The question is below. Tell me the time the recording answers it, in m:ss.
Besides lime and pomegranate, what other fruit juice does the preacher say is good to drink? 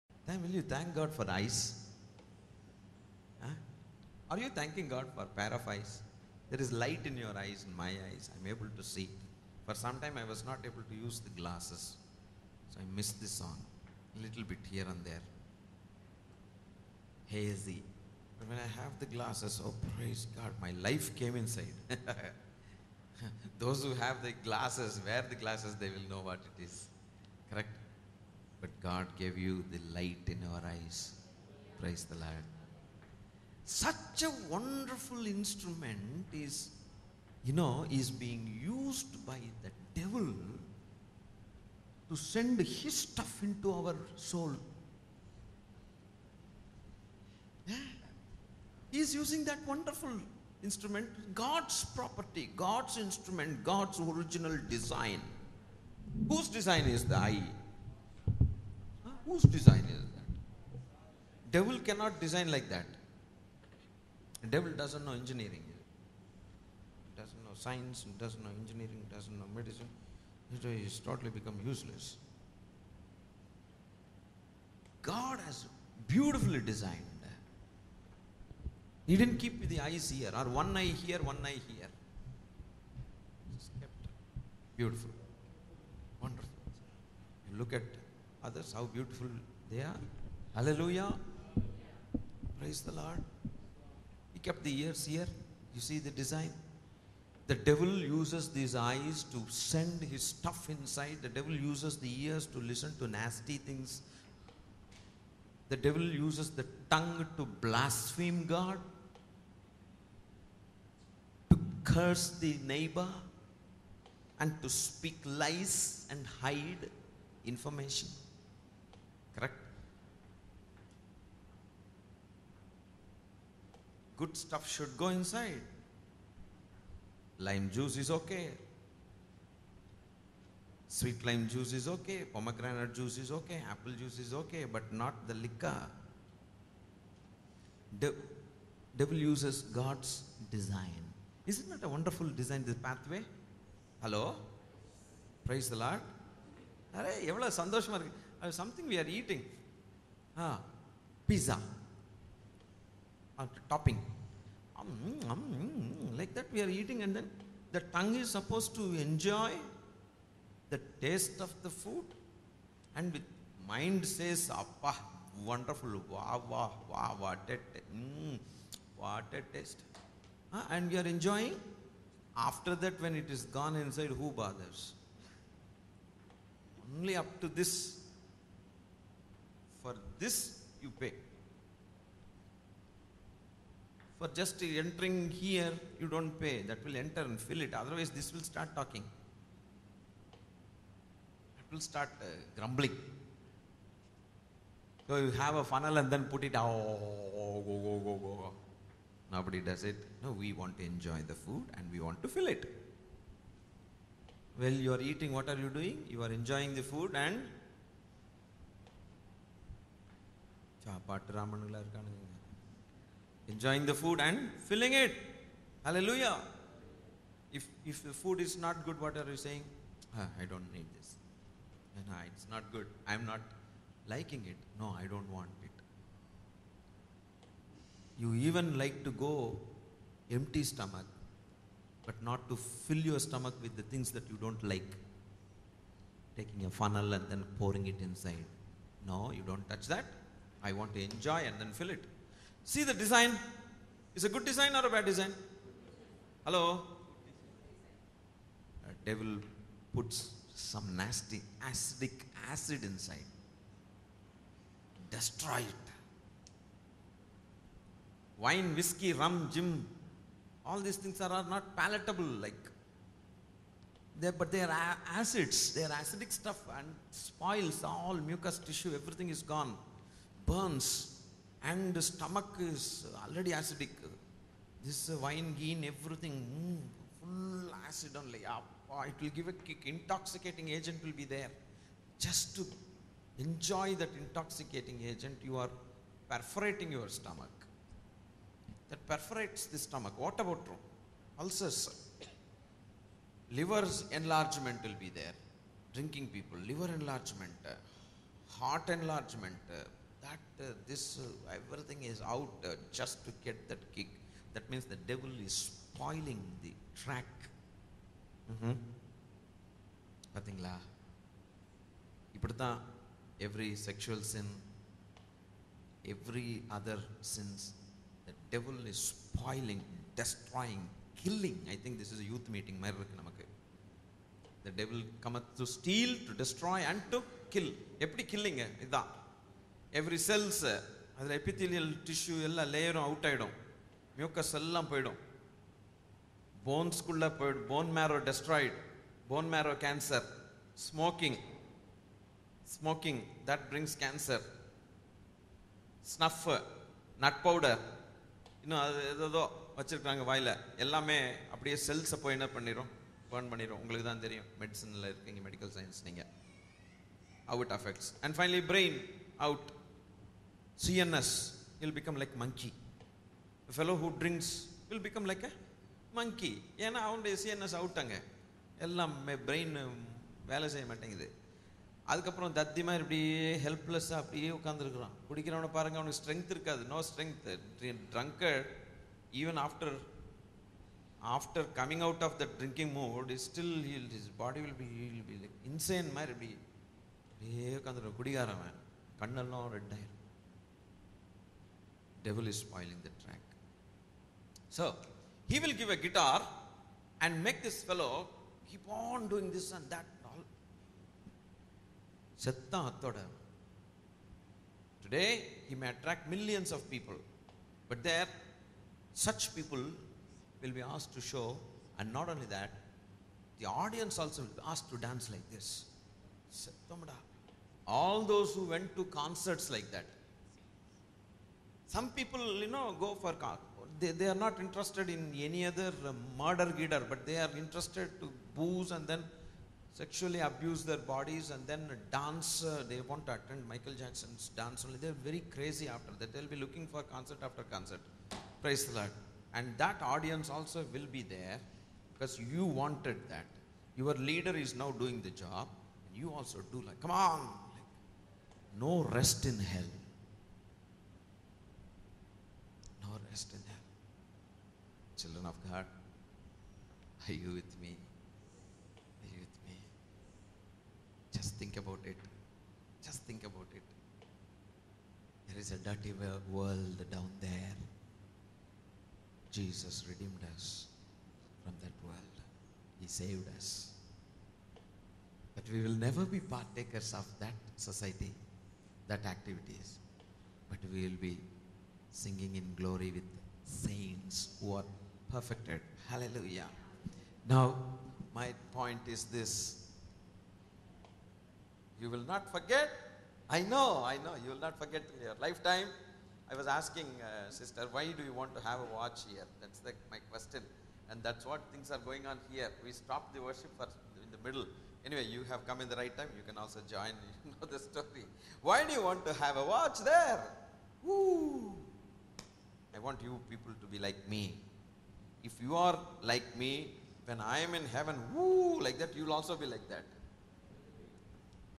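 2:13.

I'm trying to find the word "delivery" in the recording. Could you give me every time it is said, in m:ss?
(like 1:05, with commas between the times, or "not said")
not said.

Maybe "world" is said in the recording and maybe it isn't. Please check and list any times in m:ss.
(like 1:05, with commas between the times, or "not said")
7:46, 7:52.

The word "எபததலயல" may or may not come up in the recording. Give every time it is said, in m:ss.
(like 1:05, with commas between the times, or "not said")
5:31.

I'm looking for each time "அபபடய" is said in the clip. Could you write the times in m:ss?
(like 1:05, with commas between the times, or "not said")
5:51, 6:14, 6:27.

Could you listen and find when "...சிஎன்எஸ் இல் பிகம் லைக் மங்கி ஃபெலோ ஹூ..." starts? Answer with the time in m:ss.
6:00.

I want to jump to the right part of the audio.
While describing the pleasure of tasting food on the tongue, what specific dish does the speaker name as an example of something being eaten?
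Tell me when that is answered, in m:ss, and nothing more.
2:31.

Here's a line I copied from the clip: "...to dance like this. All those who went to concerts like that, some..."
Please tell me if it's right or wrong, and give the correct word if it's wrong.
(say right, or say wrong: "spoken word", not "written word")
right.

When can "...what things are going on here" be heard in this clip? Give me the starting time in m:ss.
8:21.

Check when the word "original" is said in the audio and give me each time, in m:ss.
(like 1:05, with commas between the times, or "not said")
0:53.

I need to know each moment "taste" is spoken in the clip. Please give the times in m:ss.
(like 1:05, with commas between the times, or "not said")
2:40, 2:49.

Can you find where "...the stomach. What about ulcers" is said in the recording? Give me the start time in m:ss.
4:49.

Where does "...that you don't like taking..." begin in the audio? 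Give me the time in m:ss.
3:54.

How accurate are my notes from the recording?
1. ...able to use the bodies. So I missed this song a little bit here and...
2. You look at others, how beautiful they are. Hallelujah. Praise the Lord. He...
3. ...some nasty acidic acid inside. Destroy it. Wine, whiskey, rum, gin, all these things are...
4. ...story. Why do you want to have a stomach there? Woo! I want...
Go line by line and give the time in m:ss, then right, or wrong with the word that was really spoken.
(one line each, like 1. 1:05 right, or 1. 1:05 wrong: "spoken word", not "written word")
1. 0:10 wrong: "glasses", not "bodies"
2. 1:27 right
3. 4:10 right
4. 8:27 wrong: "watch", not "stomach".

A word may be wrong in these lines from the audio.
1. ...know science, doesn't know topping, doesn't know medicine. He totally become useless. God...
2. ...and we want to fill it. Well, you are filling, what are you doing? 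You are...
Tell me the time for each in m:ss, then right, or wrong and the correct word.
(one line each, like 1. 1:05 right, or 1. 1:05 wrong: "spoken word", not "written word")
1. 1:07 wrong: "engineering", not "topping"
2. 3:21 wrong: "eating", not "filling".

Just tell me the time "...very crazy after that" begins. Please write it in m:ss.
7:15.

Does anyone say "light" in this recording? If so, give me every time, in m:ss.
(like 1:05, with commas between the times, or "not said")
0:06, 0:29.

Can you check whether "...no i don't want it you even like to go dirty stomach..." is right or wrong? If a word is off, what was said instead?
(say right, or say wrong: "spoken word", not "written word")
wrong: "empty", not "dirty".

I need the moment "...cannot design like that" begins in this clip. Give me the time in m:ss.
1:01.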